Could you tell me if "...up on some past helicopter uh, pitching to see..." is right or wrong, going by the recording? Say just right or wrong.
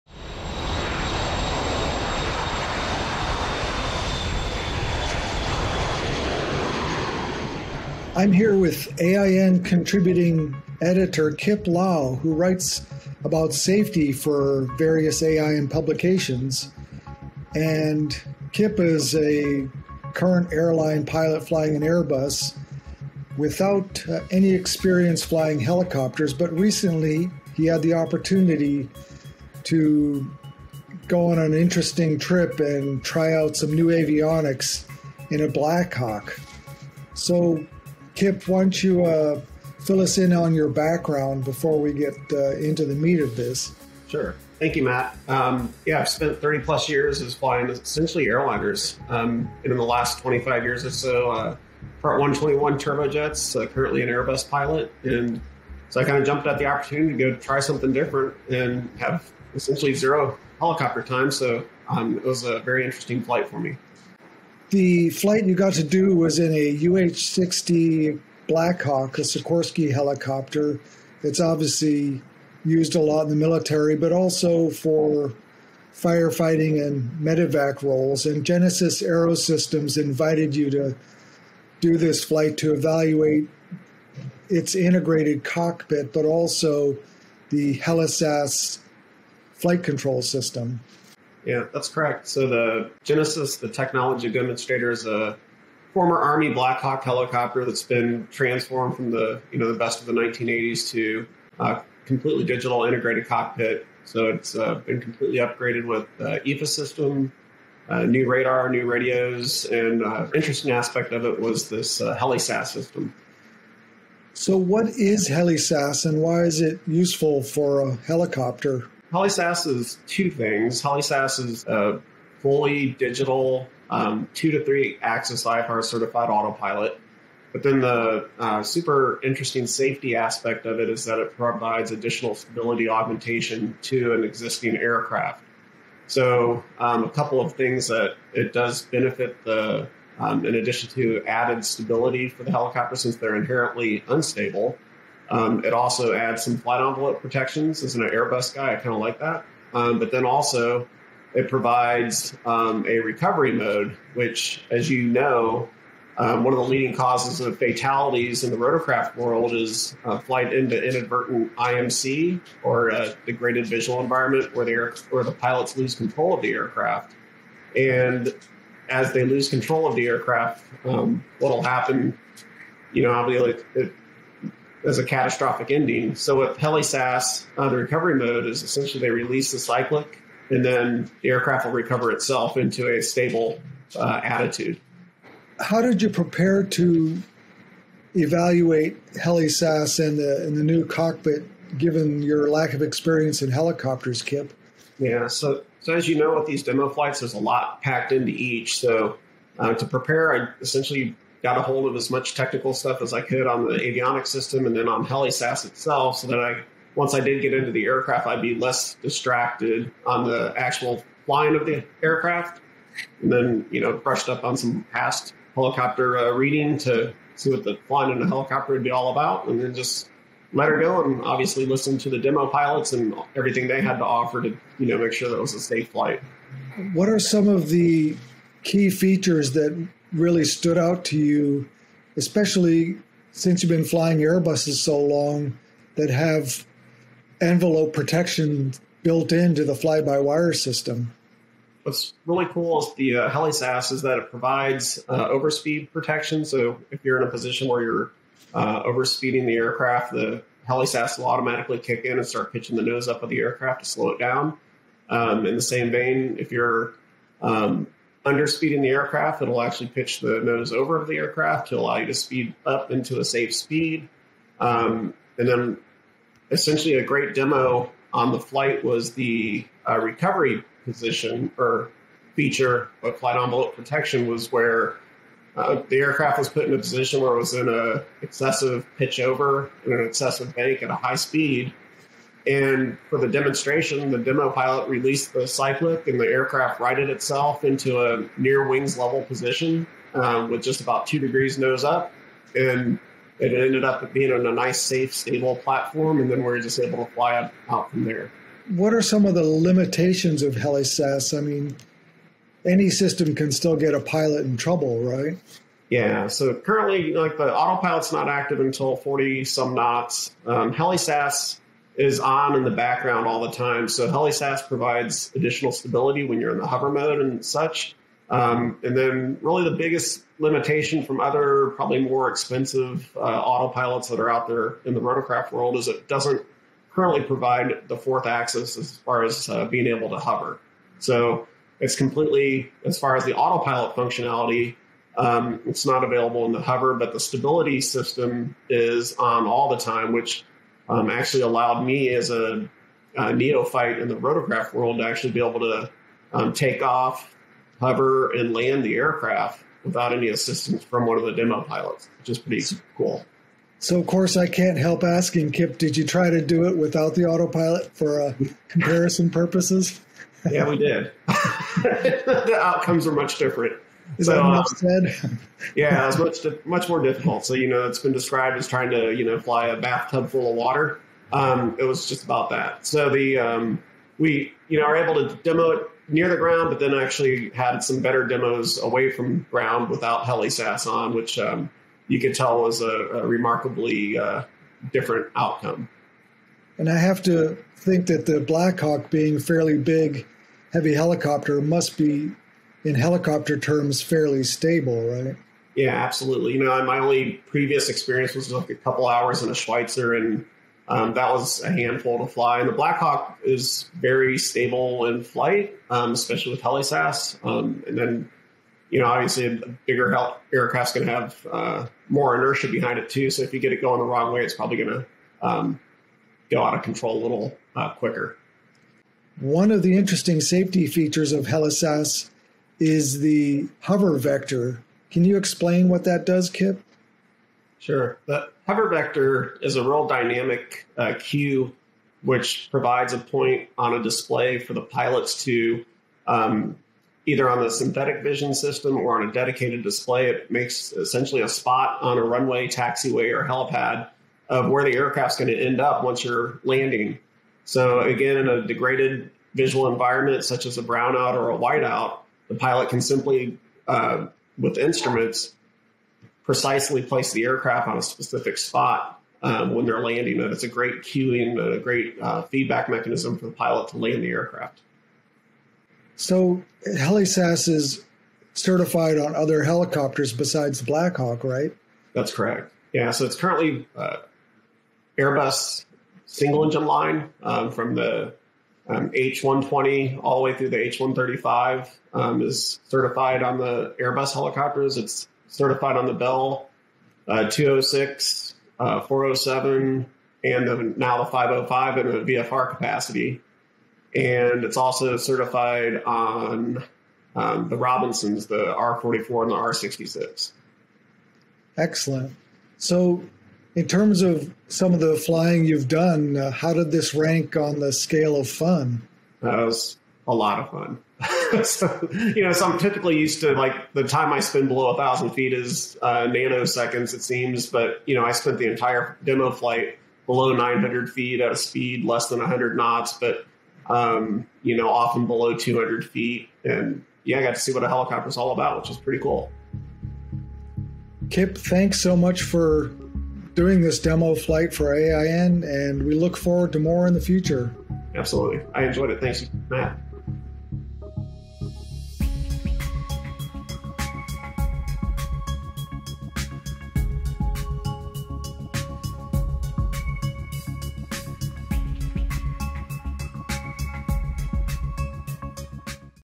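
wrong.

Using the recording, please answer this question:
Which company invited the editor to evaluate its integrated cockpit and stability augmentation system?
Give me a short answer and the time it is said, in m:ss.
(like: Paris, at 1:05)
Genesys Aerosystems, at 1:18.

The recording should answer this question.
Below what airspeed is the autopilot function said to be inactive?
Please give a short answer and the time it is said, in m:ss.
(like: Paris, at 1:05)
40 some knots, at 5:08.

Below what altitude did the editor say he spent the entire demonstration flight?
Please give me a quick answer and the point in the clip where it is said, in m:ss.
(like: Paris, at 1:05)
900 feet, at 8:40.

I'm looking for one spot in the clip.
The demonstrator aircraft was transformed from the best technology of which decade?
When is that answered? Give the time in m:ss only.
1:40.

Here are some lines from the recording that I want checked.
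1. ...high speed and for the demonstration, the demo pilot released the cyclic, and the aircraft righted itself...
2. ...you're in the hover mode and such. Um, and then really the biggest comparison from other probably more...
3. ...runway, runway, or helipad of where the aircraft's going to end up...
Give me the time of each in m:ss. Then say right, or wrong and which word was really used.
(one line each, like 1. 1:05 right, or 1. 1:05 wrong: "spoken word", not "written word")
1. 4:40 right
2. 5:16 wrong: "limitation", not "comparison"
3. 7:22 wrong: "taxiway", not "runway".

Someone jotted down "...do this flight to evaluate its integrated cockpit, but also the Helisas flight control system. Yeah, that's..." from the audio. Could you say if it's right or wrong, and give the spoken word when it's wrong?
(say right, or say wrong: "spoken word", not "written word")
right.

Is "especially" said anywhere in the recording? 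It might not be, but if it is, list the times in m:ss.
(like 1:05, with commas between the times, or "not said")
3:52, 6:46.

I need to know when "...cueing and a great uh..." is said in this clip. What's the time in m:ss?
7:41.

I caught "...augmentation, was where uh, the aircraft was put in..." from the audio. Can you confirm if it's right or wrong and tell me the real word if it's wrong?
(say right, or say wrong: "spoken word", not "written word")
wrong: "protection", not "augmentation".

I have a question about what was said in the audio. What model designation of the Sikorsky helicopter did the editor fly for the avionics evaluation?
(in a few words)
UH-60.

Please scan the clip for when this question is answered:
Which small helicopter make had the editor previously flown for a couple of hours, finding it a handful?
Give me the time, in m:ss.
6:39.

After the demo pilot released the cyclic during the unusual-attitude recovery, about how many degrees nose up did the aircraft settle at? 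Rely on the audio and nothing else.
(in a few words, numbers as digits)
2.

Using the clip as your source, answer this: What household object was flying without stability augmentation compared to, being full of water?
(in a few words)
a bathtub.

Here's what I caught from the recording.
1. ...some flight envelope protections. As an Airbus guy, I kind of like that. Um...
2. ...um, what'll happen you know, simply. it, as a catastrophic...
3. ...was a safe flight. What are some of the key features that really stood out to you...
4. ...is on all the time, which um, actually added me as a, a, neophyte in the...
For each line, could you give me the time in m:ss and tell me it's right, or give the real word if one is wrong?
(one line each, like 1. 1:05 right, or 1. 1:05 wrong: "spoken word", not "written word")
1. 2:26 right
2. 2:50 wrong: "obviously", not "simply"
3. 3:45 right
4. 5:38 wrong: "allowed", not "added".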